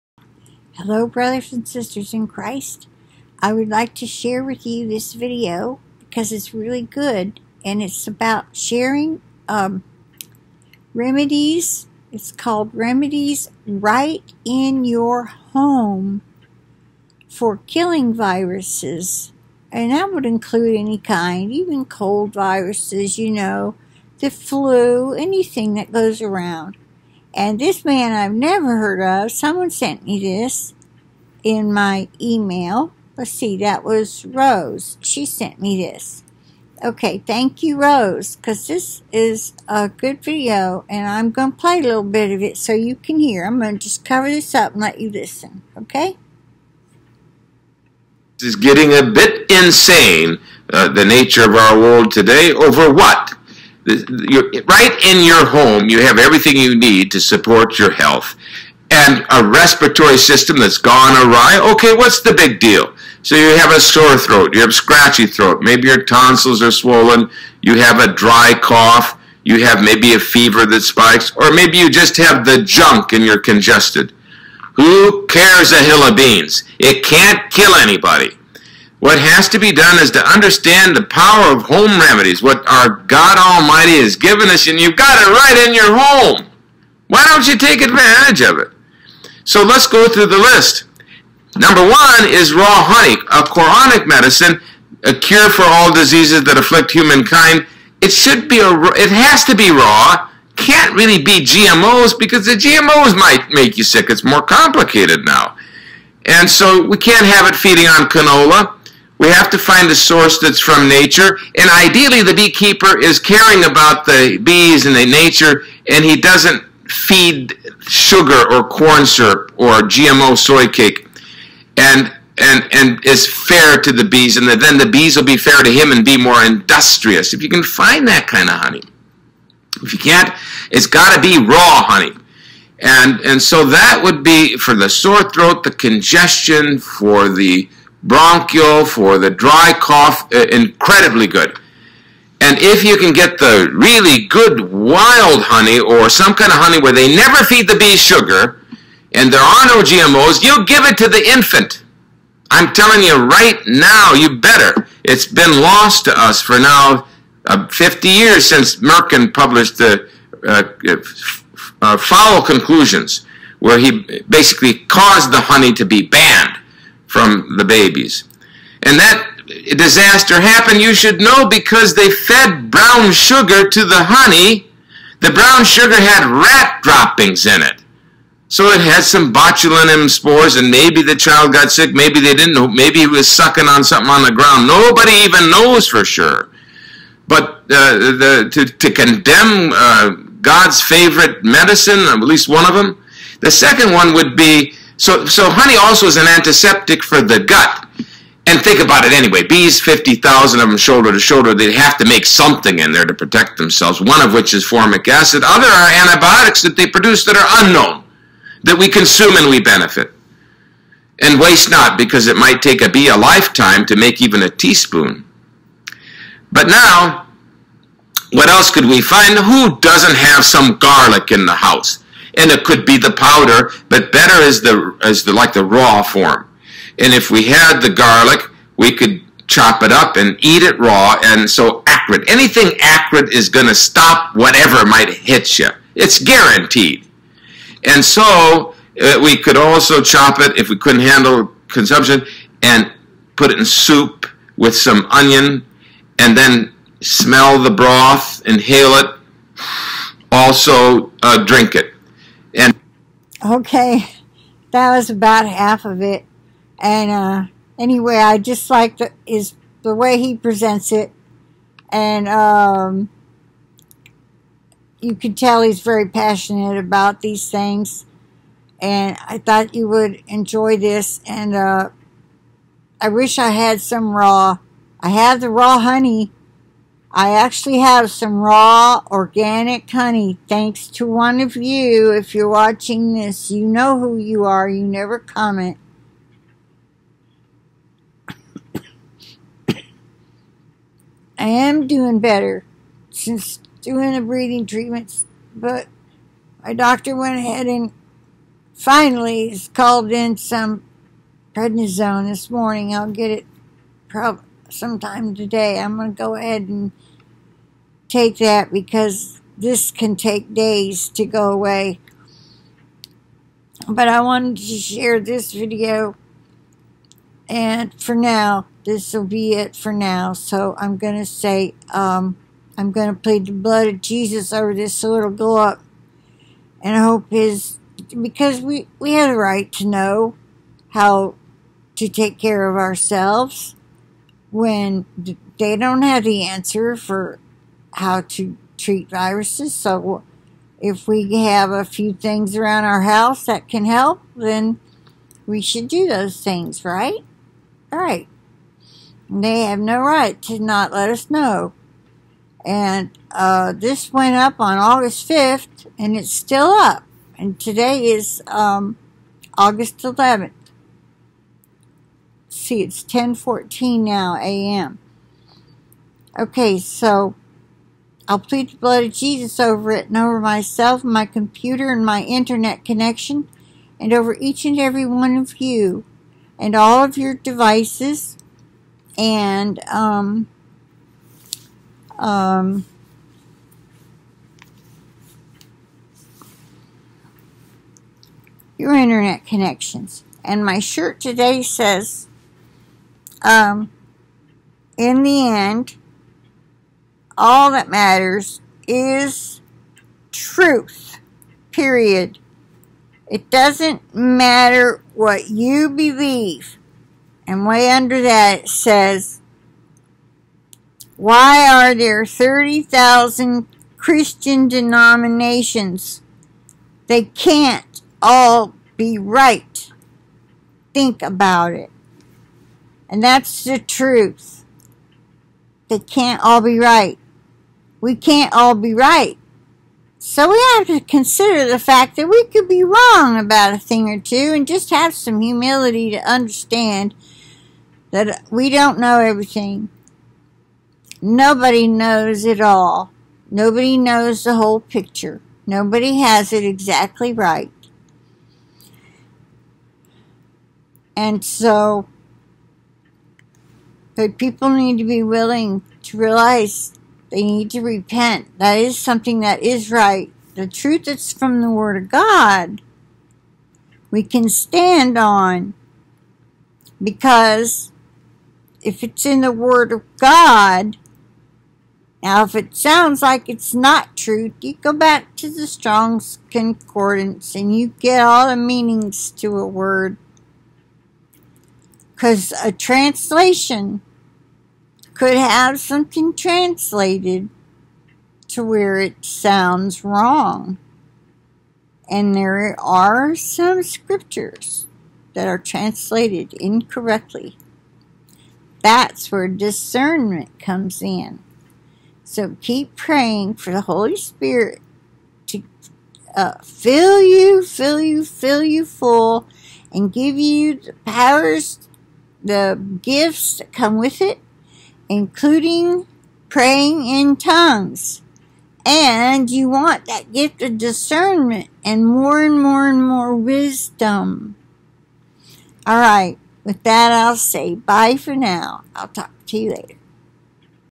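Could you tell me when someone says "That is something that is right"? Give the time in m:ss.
7:38.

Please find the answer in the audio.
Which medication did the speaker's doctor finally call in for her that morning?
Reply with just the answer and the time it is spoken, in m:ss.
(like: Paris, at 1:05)
prednisone, at 5:01.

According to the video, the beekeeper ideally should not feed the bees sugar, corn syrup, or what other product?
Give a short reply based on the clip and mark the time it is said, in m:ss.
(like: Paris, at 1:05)
GMO soy cake, at 1:59.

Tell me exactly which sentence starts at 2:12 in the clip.
And, and so that would be for the sore throat, the congestion, for the bronchial, for the dry cough, uh, incredibly good.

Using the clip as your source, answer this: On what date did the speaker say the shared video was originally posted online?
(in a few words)
August 5th.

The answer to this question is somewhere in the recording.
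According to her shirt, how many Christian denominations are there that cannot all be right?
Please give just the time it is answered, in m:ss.
6:52.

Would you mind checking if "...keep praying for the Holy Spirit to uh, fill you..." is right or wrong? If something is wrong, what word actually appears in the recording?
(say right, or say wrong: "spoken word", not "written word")
right.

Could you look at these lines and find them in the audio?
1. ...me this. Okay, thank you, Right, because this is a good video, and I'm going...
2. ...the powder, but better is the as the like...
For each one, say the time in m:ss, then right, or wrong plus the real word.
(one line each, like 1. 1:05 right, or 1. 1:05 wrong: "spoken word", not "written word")
1. 0:35 wrong: "Rose", not "Right"
2. 3:42 right.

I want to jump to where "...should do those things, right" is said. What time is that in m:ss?
5:45.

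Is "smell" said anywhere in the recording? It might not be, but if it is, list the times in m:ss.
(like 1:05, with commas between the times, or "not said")
4:07.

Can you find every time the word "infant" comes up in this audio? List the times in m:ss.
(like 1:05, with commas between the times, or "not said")
2:31.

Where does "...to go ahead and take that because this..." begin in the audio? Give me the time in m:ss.
5:06.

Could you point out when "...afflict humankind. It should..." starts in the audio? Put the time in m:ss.
1:36.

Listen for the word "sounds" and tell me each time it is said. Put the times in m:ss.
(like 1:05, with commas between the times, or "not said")
7:52, 8:09.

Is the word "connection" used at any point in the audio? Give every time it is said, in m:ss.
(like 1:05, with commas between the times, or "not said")
6:12, 6:29.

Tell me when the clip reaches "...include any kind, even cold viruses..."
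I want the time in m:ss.
0:20.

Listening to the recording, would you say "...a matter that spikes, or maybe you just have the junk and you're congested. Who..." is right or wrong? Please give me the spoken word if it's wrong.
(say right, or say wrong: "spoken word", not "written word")
wrong: "fever", not "matter".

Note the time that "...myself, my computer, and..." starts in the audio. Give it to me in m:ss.
6:10.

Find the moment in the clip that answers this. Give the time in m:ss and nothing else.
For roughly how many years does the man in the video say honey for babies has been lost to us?
2:37.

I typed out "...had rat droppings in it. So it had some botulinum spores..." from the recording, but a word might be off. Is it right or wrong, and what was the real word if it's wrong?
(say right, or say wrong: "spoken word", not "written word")
right.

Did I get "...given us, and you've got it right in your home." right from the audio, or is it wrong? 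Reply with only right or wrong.
right.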